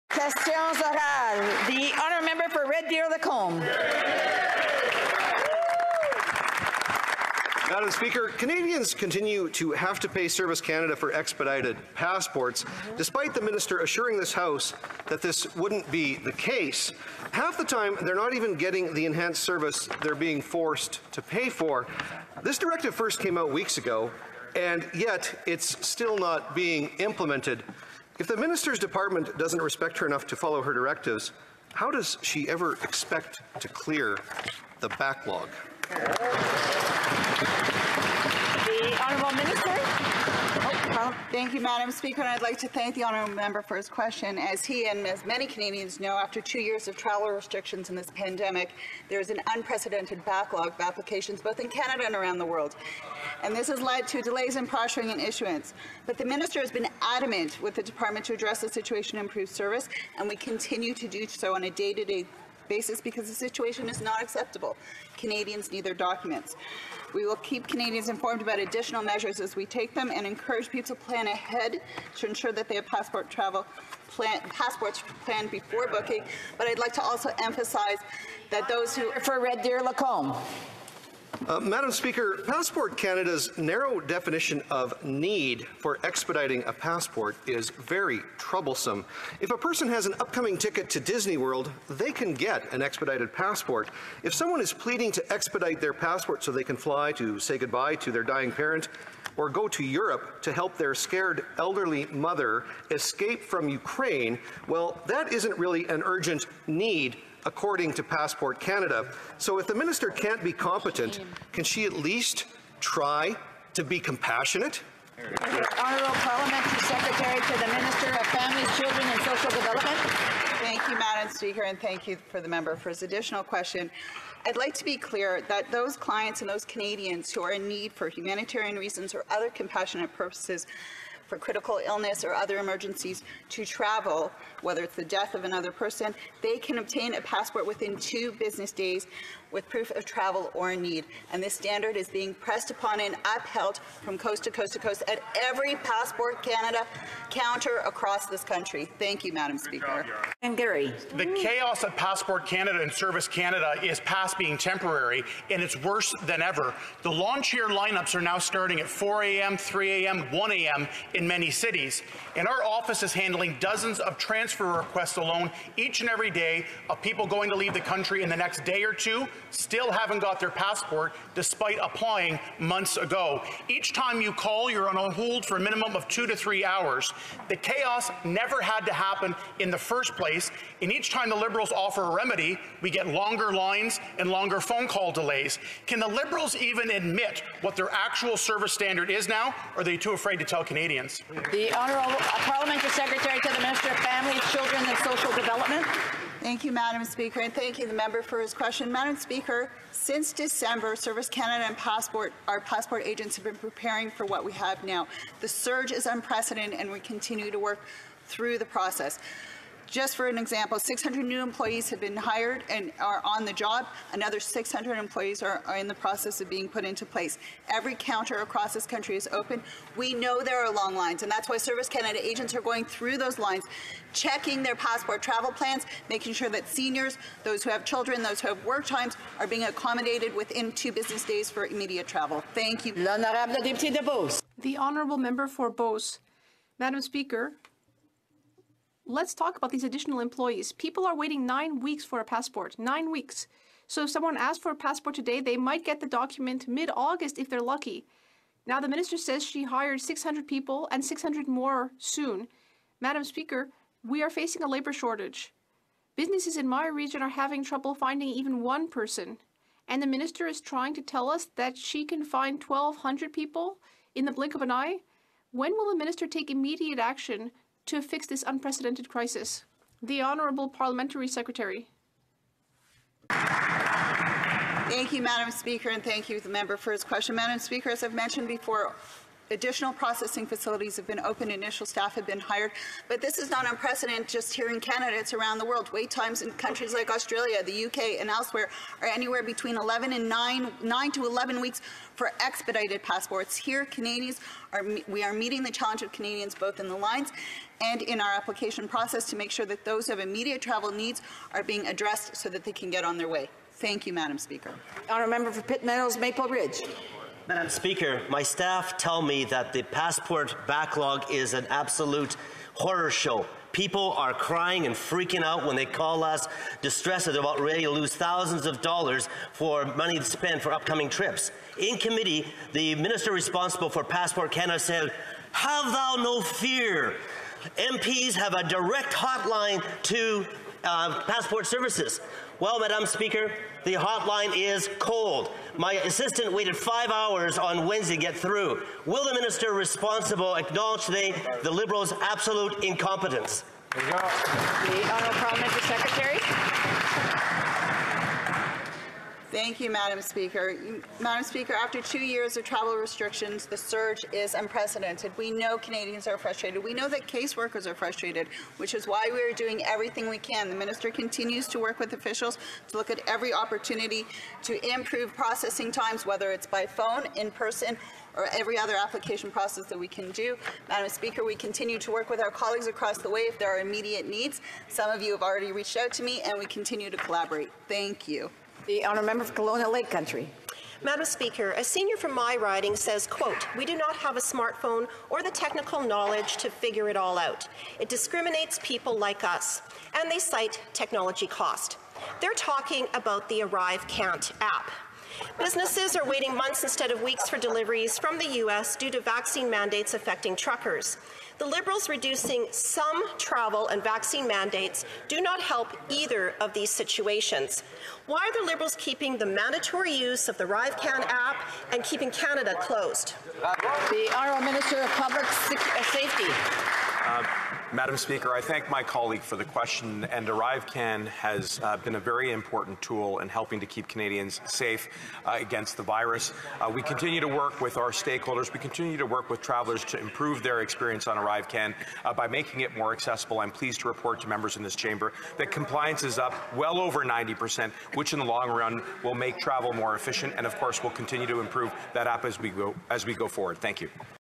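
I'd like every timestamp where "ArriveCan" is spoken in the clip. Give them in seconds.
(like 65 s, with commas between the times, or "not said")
393 s, 410 s, 420 s, 431 s.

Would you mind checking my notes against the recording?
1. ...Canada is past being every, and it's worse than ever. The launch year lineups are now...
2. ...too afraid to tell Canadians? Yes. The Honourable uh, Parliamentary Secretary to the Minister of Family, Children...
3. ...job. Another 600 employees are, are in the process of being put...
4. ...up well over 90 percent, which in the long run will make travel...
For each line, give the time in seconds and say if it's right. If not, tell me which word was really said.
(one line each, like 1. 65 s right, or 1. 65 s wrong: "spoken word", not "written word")
1. 153 s wrong: "temporary", not "every"
2. 189 s right
3. 213 s right
4. 436 s right.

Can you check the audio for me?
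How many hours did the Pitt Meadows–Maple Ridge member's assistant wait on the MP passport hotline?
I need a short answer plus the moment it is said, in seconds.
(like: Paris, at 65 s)
5, at 336 s.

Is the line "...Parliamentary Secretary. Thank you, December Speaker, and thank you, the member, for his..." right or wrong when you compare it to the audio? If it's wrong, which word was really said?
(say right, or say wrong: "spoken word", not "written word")
wrong: "Madam", not "December".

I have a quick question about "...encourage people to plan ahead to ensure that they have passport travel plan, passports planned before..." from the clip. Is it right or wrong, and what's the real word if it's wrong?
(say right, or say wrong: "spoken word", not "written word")
right.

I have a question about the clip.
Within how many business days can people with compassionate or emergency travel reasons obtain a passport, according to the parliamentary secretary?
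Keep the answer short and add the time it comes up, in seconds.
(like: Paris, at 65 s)
2, at 137 s.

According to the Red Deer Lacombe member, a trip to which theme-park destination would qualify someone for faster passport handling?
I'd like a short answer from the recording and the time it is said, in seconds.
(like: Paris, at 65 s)
Disney World, at 90 s.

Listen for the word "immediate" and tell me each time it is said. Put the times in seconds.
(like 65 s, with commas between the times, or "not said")
231 s, 266 s, 300 s, 373 s.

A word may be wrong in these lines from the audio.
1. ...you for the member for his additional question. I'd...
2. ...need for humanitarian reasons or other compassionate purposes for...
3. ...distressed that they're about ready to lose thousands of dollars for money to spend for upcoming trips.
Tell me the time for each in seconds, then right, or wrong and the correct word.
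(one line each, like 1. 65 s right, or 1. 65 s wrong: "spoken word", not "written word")
1. 122 s right
2. 127 s right
3. 316 s right.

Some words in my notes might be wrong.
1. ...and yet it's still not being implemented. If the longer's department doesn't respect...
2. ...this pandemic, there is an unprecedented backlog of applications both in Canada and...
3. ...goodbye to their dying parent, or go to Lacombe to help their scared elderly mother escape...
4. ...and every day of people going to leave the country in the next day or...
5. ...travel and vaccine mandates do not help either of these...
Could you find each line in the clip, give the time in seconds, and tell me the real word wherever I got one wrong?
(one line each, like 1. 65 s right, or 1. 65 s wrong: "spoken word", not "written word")
1. 24 s wrong: "minister", not "longer"
2. 47 s right
3. 97 s wrong: "Europe", not "Lacombe"
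4. 166 s right
5. 403 s right.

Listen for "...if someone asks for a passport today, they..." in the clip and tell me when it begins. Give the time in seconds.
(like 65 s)
244 s.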